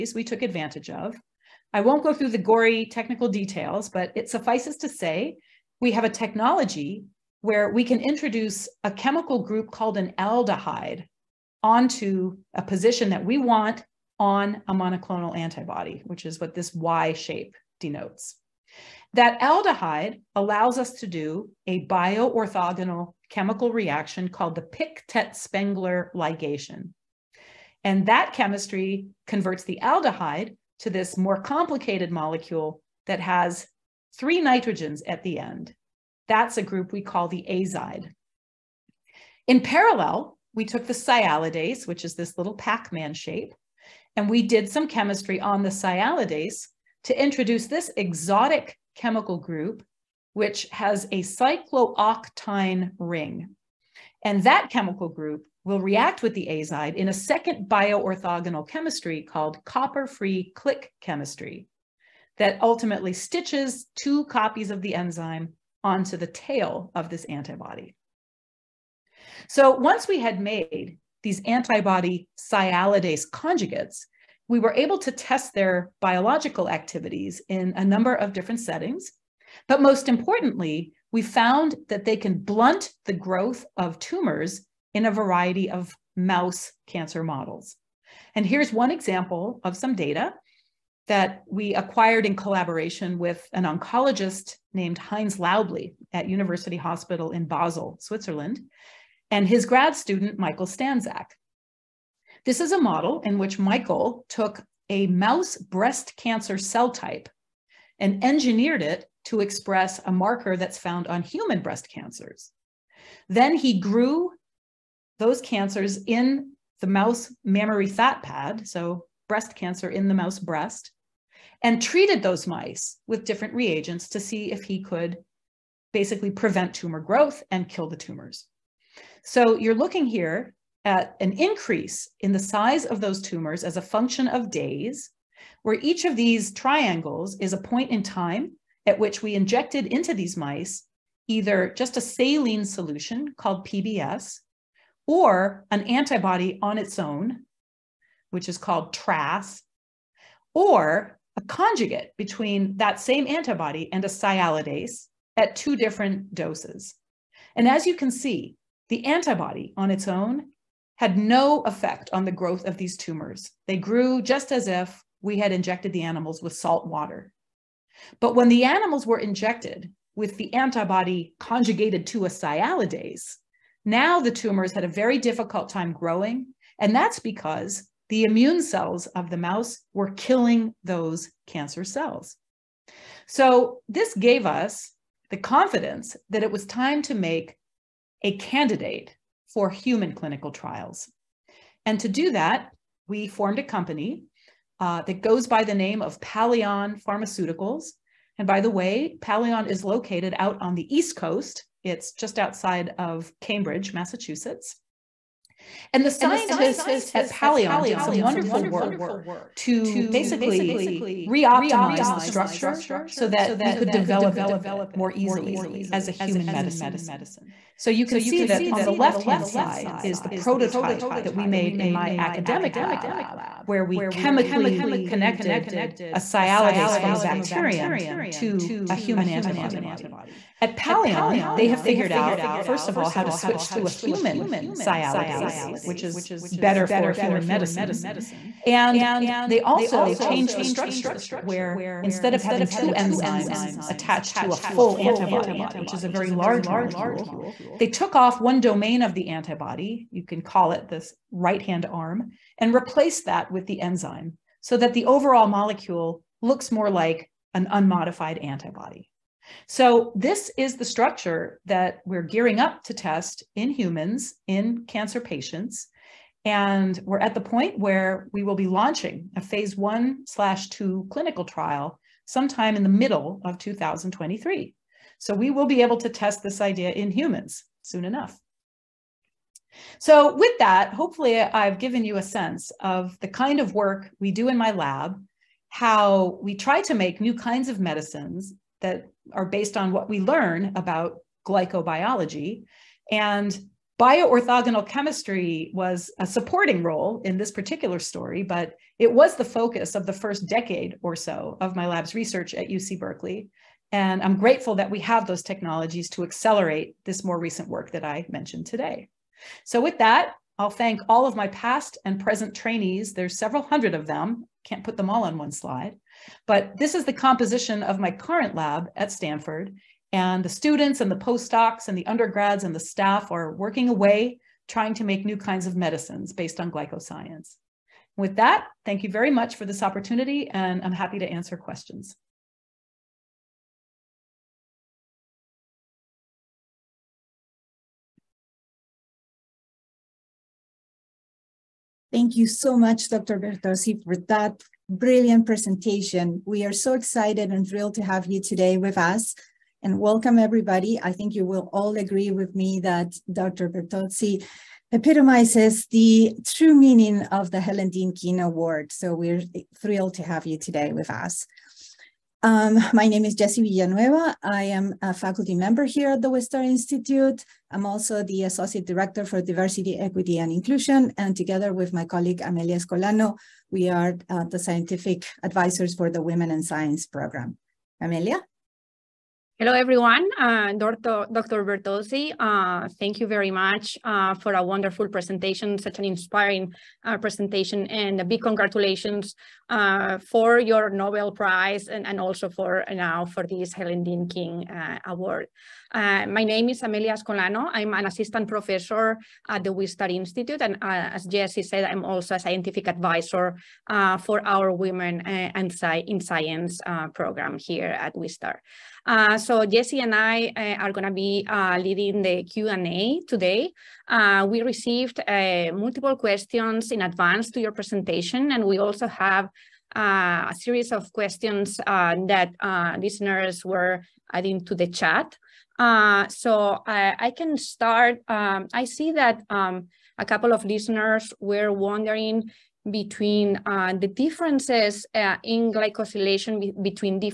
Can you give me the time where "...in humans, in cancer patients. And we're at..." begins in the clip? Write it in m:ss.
4:23.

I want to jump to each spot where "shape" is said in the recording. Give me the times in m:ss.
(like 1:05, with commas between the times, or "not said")
0:17, 0:43.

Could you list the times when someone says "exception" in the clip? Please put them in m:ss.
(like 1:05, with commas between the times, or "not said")
not said.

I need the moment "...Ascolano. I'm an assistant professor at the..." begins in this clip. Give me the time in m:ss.
6:37.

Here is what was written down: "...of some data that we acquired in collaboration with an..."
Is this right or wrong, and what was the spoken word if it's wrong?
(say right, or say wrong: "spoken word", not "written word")
right.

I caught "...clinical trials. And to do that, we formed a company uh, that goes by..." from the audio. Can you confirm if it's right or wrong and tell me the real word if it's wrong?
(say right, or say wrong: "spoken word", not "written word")
right.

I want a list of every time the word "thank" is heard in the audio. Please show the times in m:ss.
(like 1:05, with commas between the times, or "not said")
5:10, 5:28, 5:42, 6:23.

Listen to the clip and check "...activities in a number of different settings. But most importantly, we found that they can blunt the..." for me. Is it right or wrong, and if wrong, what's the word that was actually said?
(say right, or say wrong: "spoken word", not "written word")
right.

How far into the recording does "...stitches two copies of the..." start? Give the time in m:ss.
1:03.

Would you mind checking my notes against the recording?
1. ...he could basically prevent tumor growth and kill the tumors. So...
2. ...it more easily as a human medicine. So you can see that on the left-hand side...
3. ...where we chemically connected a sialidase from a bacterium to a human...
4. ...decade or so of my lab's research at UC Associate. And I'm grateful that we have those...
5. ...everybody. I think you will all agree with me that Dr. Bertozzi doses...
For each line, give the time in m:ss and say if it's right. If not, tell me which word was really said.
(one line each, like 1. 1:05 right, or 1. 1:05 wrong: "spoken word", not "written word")
1. 2:04 right
2. 3:34 right
3. 3:43 right
4. 5:00 wrong: "Berkeley", not "Associate"
5. 5:50 wrong: "epitomizes", not "doses".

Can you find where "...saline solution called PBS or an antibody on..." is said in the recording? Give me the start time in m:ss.
2:22.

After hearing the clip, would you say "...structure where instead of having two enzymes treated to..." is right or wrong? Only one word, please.
wrong.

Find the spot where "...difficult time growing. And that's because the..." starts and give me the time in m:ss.
2:55.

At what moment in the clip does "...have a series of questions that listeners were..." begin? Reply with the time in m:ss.
6:59.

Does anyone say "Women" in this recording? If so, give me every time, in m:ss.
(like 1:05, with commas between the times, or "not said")
6:16, 6:44.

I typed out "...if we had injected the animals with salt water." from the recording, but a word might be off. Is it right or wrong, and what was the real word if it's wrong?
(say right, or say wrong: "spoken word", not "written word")
right.